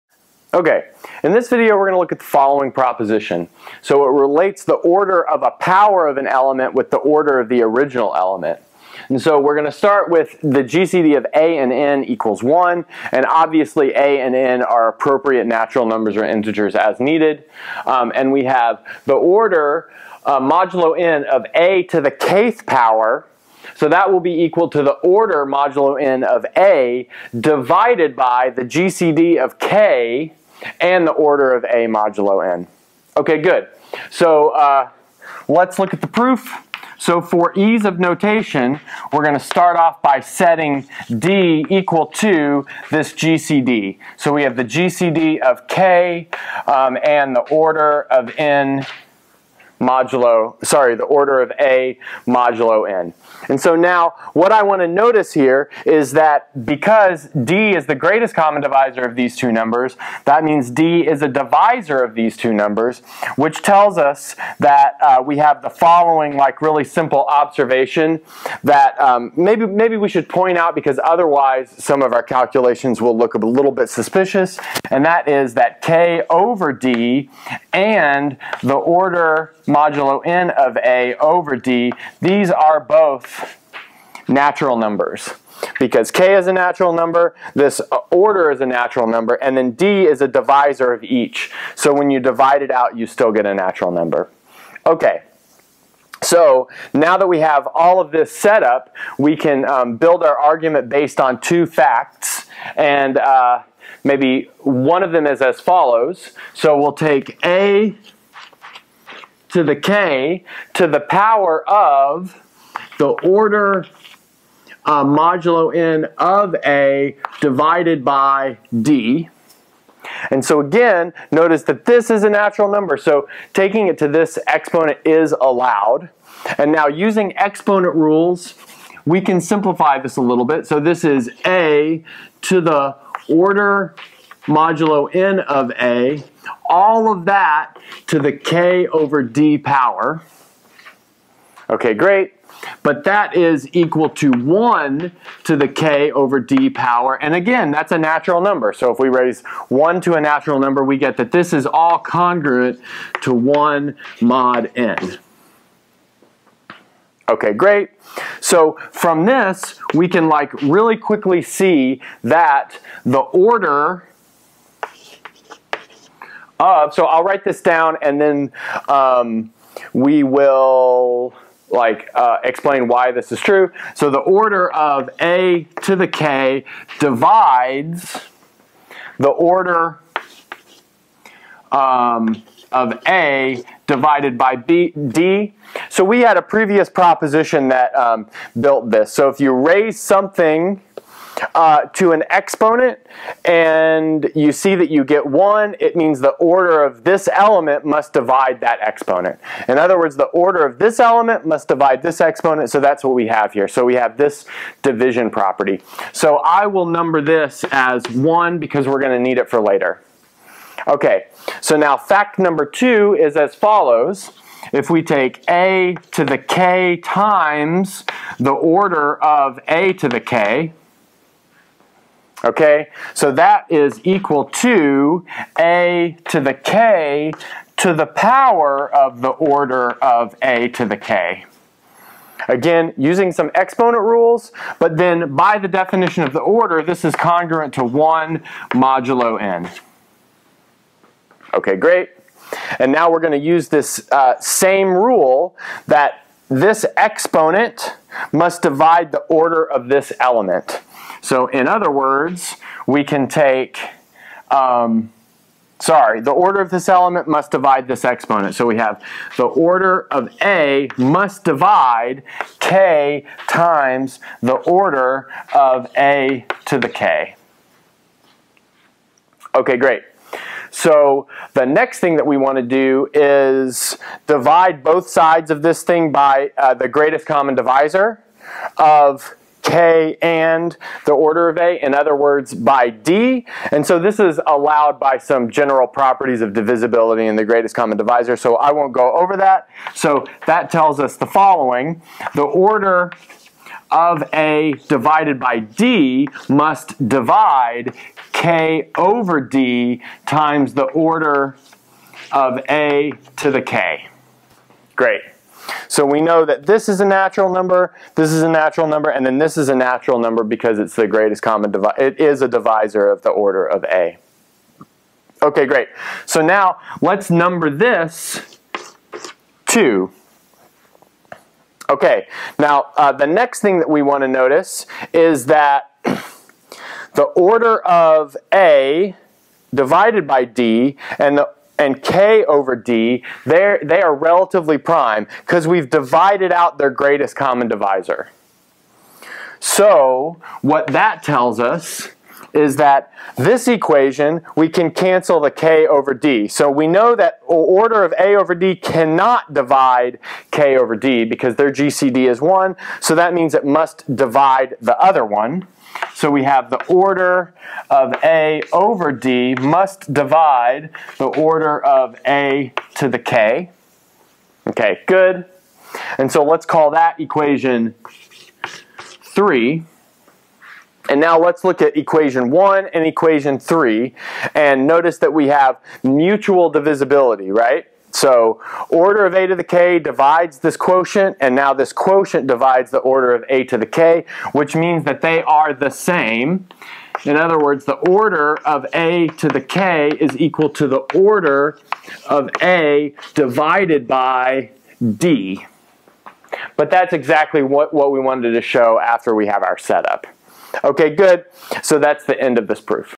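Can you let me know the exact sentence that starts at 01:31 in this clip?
So when you divide it out, you still get a natural number.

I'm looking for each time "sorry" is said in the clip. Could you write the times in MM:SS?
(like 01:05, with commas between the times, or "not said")
00:50, 04:15.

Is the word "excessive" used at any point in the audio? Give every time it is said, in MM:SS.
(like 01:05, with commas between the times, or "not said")
not said.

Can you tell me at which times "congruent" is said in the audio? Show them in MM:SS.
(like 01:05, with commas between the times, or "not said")
02:31, 03:57.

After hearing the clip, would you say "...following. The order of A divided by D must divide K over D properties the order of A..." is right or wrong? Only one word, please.
wrong.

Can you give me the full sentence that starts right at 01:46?
So we'll take a to the k to the power of the order uh, modulo n of a divided by d.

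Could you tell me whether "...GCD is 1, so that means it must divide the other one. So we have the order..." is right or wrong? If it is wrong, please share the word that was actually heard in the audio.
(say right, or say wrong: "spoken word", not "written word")
right.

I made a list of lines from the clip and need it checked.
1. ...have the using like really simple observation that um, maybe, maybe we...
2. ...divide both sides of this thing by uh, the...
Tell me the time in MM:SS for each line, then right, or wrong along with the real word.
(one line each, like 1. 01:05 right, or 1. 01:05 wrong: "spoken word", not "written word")
1. 01:05 wrong: "following", not "using"
2. 04:34 right.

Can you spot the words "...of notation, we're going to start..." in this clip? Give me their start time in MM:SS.
00:37.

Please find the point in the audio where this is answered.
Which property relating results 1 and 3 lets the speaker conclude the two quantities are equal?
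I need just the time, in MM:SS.
06:16.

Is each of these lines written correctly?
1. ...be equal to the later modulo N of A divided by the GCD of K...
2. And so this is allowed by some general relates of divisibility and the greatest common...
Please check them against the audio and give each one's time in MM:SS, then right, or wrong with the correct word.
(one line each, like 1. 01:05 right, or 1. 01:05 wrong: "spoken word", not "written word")
1. 00:24 wrong: "order", not "later"
2. 04:43 wrong: "properties", not "relates".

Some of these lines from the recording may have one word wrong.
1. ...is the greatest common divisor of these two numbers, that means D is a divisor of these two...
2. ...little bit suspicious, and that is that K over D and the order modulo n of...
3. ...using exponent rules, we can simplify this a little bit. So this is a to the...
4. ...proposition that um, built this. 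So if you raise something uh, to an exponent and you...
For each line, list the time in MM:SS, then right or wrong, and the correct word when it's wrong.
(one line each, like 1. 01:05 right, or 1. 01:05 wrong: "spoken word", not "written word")
1. 00:57 right
2. 01:13 right
3. 02:06 right
4. 03:06 right.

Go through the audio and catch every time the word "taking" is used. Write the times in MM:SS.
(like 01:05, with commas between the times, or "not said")
02:03.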